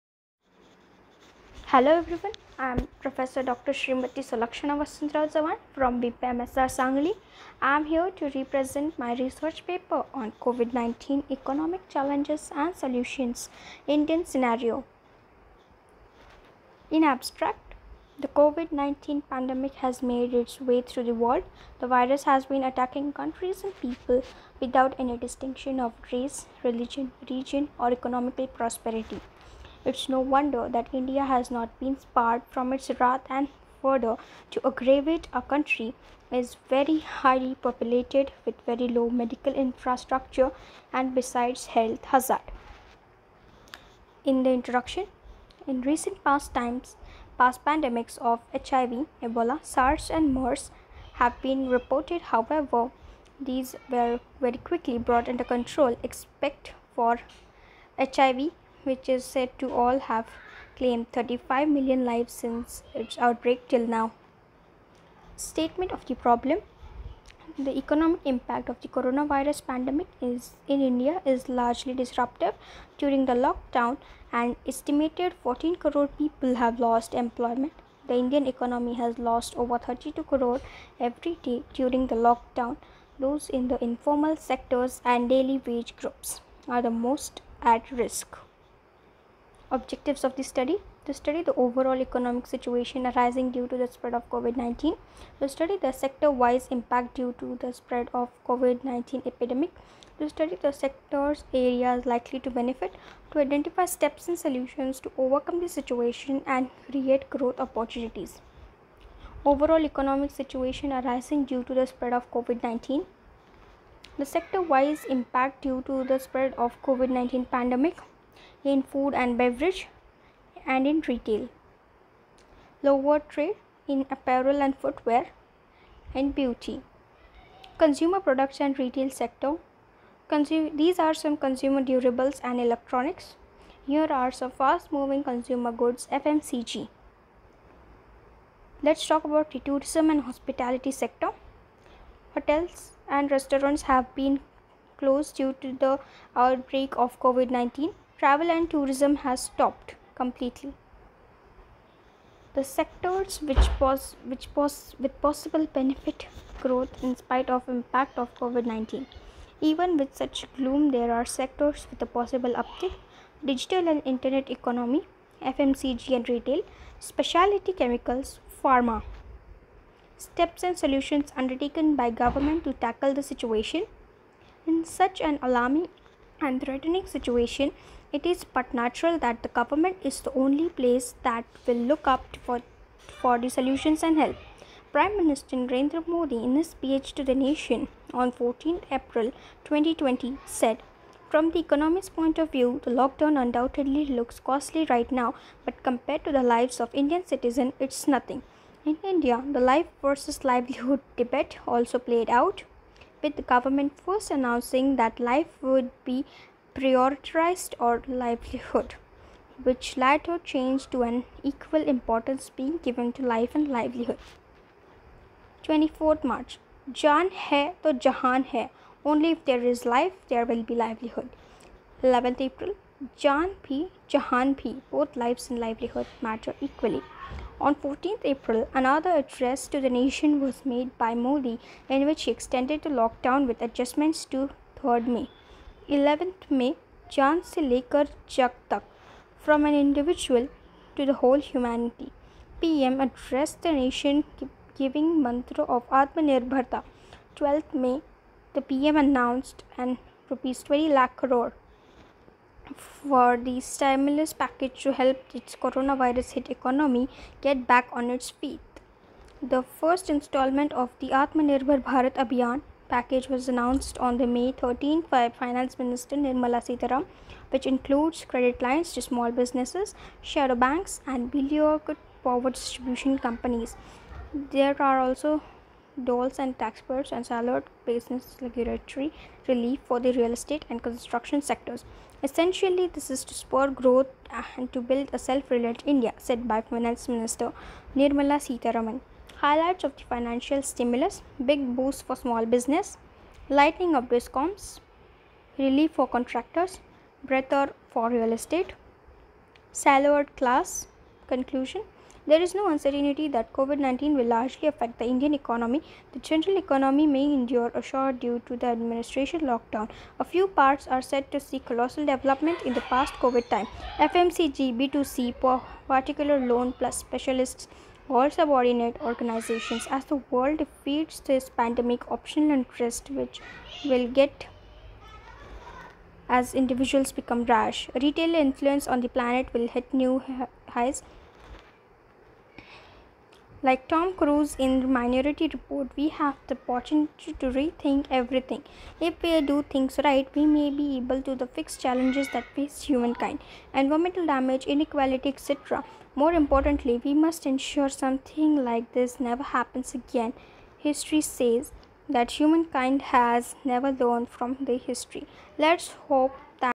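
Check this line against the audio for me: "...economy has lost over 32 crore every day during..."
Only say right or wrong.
right.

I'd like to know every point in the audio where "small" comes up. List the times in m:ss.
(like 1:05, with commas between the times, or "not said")
4:29, 4:52.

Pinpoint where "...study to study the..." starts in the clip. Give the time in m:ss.
1:30.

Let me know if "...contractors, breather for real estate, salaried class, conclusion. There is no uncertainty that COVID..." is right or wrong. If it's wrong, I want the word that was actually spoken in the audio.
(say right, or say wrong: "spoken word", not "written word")
right.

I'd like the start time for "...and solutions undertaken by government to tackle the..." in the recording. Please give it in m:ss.
2:50.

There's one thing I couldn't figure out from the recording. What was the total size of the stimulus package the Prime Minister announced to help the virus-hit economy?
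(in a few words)
20 lakh crore rupees.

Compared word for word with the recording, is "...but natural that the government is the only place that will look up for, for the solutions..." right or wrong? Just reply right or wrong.
right.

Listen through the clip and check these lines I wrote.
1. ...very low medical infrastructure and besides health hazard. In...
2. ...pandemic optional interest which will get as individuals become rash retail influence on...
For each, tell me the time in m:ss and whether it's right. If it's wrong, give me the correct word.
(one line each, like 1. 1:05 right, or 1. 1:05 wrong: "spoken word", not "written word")
1. 0:38 right
2. 5:21 right.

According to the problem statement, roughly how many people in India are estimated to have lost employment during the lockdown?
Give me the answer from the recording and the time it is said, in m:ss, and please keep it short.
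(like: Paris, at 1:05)
14 crore, at 1:15.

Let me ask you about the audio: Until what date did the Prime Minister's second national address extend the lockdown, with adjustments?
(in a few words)
3rd May.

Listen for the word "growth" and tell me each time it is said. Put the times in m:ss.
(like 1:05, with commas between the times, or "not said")
1:47, 2:36, 4:43.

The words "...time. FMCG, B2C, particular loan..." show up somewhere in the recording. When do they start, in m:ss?
5:13.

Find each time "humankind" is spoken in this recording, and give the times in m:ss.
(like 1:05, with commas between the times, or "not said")
5:42, 5:52.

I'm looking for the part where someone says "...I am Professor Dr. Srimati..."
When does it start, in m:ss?
0:02.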